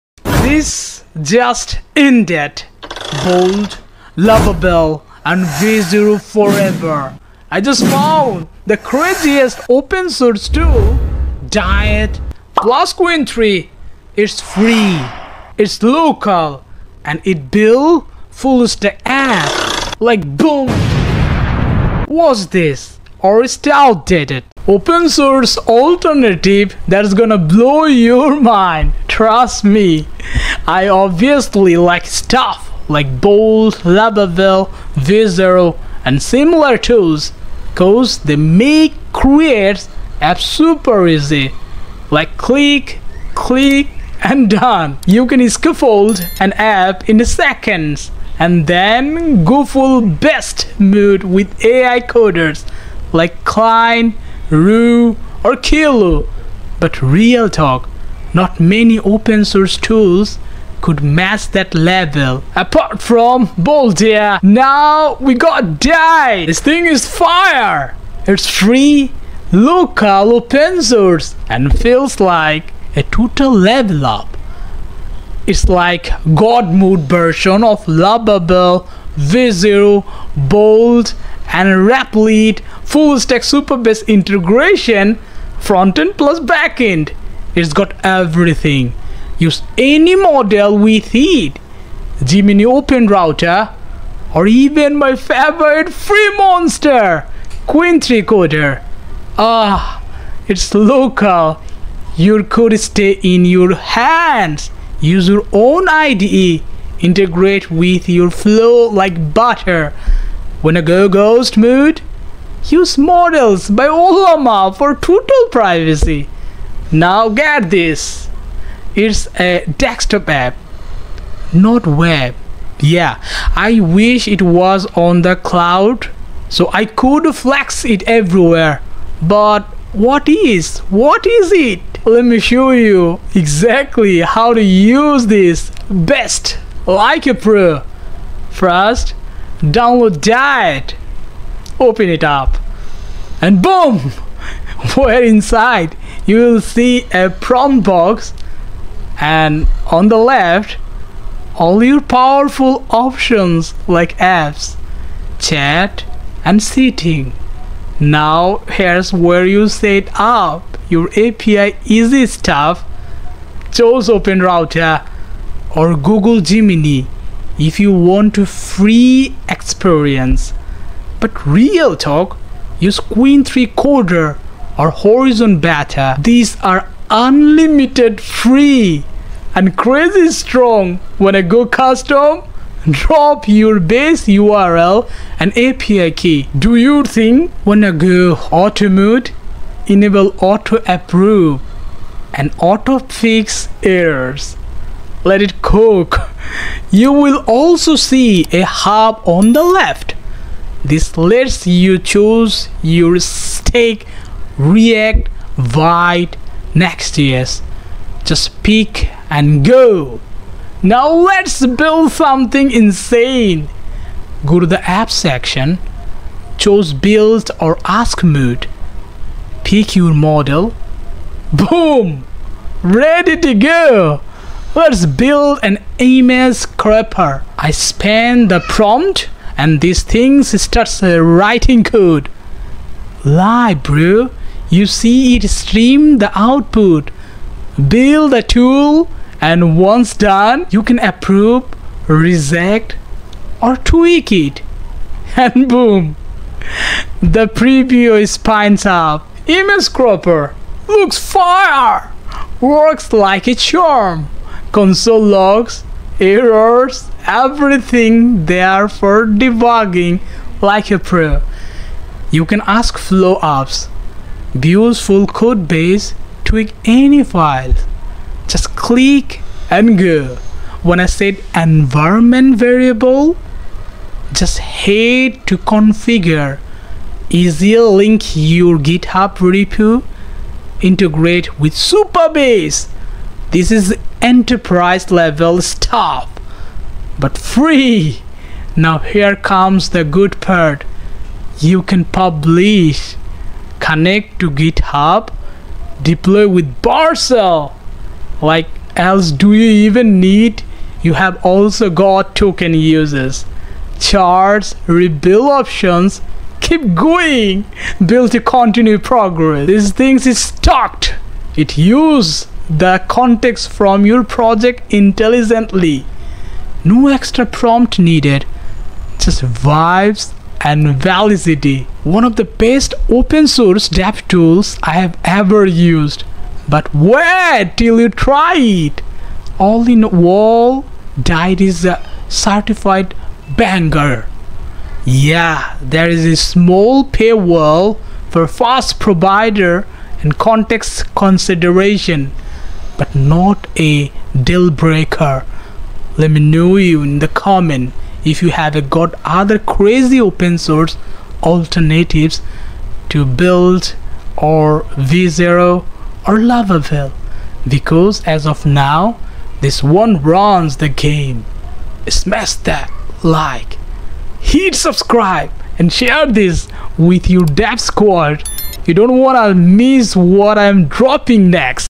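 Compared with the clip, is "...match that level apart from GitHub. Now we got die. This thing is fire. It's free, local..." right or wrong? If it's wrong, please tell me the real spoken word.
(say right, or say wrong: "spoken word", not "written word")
wrong: "Boldia", not "GitHub".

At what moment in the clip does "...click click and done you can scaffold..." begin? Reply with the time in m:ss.
0:42.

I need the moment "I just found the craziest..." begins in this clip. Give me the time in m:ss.
0:07.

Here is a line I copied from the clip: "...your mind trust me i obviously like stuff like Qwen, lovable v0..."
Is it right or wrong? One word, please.
wrong.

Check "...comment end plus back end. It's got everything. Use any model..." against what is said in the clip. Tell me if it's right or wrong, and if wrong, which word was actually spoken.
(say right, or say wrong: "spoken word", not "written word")
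wrong: "front", not "comment".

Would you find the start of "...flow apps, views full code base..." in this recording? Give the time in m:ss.
4:22.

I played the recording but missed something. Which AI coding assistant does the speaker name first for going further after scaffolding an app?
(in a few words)
Cline.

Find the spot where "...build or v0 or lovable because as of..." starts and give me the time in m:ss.
5:53.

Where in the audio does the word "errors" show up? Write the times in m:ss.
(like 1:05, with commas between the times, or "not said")
3:13, 4:16.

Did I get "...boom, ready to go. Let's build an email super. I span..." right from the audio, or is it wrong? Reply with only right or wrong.
wrong.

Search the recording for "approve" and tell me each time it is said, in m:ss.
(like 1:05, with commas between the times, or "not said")
3:10, 4:00.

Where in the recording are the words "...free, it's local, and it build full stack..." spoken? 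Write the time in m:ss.
0:14.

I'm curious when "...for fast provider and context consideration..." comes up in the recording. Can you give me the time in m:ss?
5:38.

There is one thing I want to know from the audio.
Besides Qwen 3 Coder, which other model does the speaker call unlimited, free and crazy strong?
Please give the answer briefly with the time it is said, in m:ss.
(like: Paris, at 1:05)
Horizon Beta, at 2:55.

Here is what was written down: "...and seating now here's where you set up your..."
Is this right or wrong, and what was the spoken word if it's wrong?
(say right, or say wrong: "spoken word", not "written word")
right.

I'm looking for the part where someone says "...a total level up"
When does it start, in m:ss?
1:12.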